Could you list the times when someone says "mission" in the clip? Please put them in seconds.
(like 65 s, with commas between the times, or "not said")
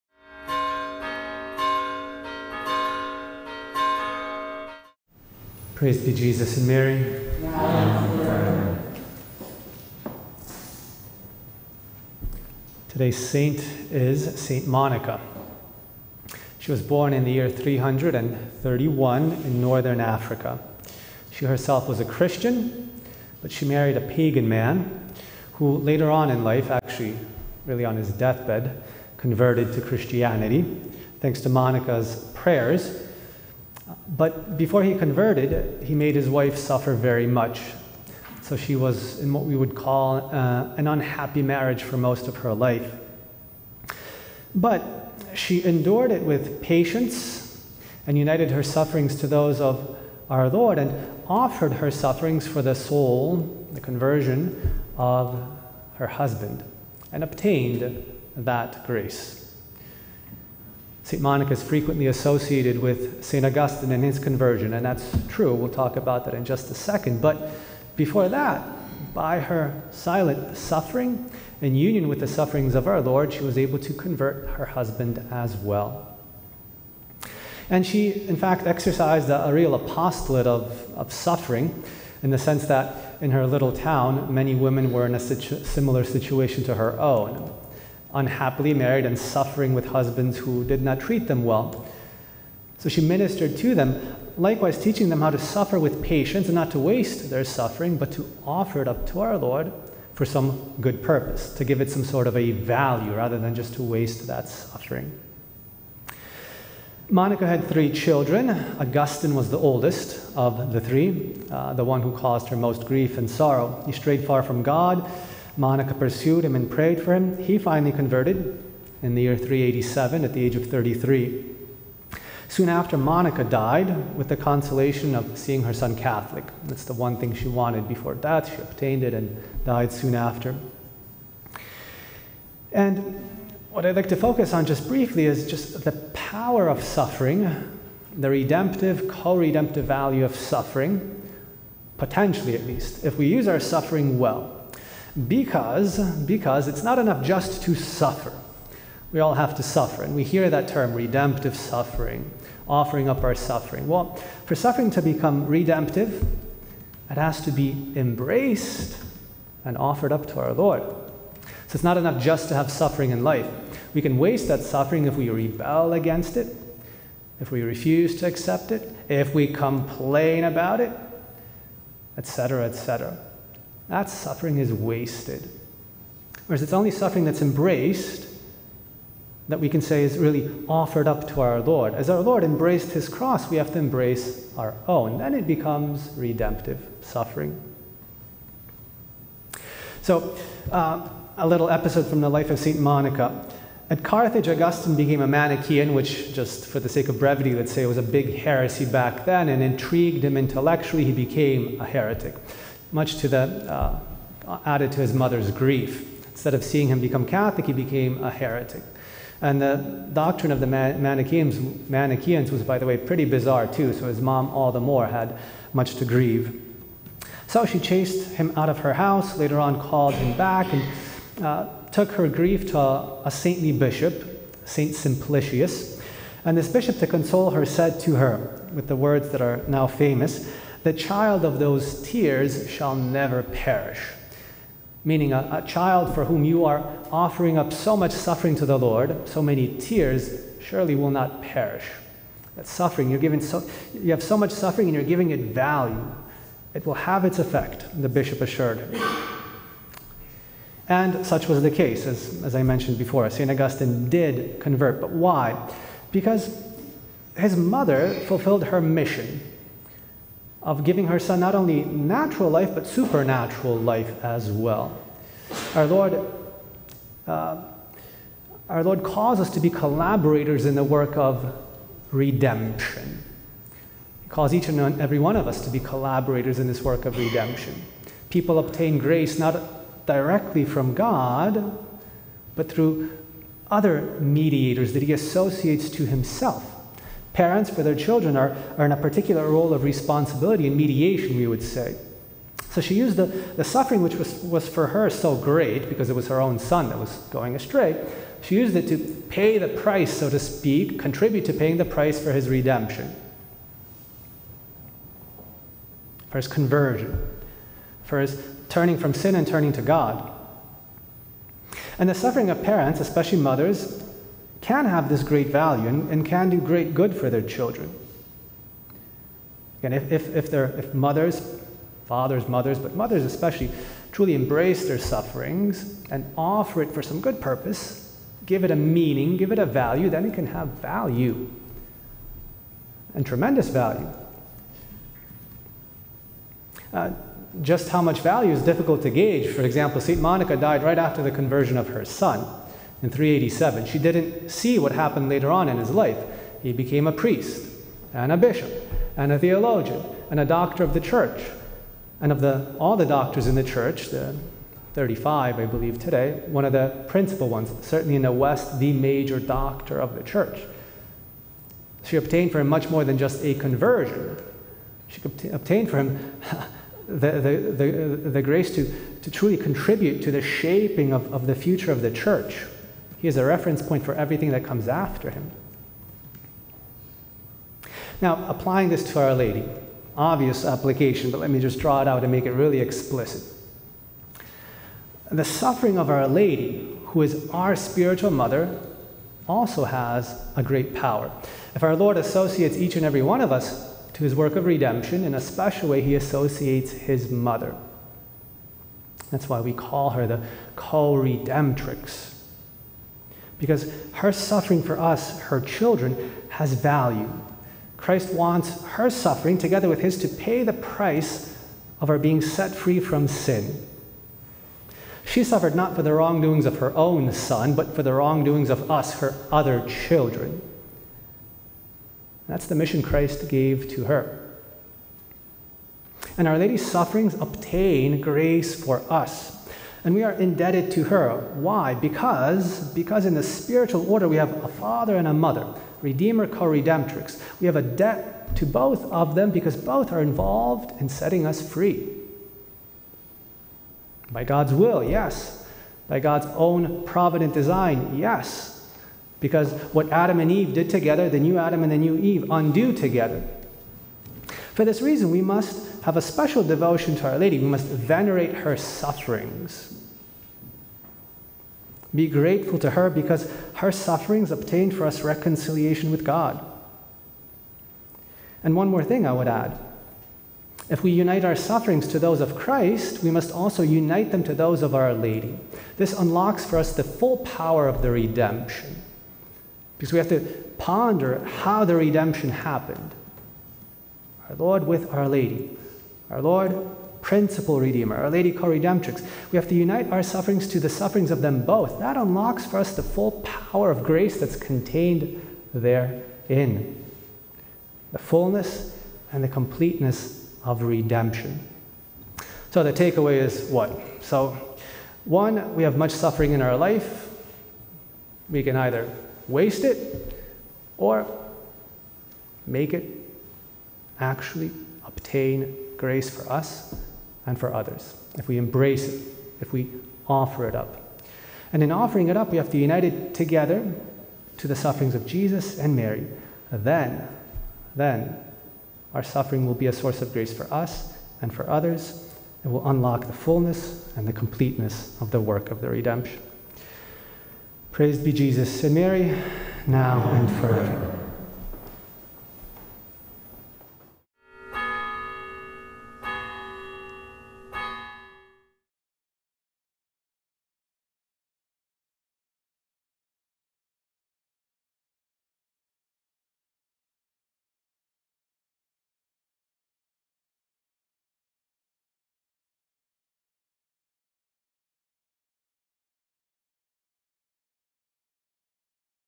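258 s, 422 s.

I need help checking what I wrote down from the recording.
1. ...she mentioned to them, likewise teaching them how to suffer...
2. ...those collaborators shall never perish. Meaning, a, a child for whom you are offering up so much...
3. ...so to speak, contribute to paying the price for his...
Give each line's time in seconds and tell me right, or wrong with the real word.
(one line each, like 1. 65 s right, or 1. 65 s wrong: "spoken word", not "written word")
1. 92 s wrong: "ministered", not "mentioned"
2. 231 s wrong: "tears", not "collaborators"
3. 300 s right.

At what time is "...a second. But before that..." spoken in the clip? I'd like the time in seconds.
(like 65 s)
66 s.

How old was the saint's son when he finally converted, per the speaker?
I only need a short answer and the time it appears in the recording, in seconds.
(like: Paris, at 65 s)
33, at 120 s.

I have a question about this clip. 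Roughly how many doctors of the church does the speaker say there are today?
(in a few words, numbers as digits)
35.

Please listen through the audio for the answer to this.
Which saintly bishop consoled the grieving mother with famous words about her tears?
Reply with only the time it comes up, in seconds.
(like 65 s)
224 s.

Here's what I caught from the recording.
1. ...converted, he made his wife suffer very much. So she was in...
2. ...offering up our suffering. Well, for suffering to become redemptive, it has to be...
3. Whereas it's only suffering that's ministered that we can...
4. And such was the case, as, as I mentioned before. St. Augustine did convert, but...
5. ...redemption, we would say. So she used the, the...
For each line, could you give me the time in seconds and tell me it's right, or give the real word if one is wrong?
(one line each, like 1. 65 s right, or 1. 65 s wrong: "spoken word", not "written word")
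1. 34 s right
2. 152 s right
3. 176 s wrong: "embraced", not "ministered"
4. 250 s right
5. 290 s wrong: "mediation", not "redemption".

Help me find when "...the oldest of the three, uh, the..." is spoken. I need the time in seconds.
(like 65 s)
109 s.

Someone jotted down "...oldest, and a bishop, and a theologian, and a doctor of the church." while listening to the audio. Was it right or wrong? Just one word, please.
wrong.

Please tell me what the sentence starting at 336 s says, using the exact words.
Uh, just how much value is difficult to gauge.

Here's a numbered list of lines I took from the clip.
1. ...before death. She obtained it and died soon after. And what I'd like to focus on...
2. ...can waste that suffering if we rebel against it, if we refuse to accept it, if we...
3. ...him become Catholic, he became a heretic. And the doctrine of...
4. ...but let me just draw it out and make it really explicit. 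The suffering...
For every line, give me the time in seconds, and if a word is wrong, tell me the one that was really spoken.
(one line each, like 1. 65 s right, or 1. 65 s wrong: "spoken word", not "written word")
1. 127 s right
2. 164 s right
3. 206 s right
4. 381 s right.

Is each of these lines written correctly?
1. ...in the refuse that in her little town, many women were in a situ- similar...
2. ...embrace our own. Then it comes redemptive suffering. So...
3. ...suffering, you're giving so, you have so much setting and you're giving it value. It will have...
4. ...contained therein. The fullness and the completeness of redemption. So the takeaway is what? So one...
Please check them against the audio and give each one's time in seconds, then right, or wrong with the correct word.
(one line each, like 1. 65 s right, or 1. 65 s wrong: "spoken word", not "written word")
1. 82 s wrong: "sense", not "refuse"
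2. 183 s wrong: "becomes", not "comes"
3. 242 s wrong: "suffering", not "setting"
4. 494 s right.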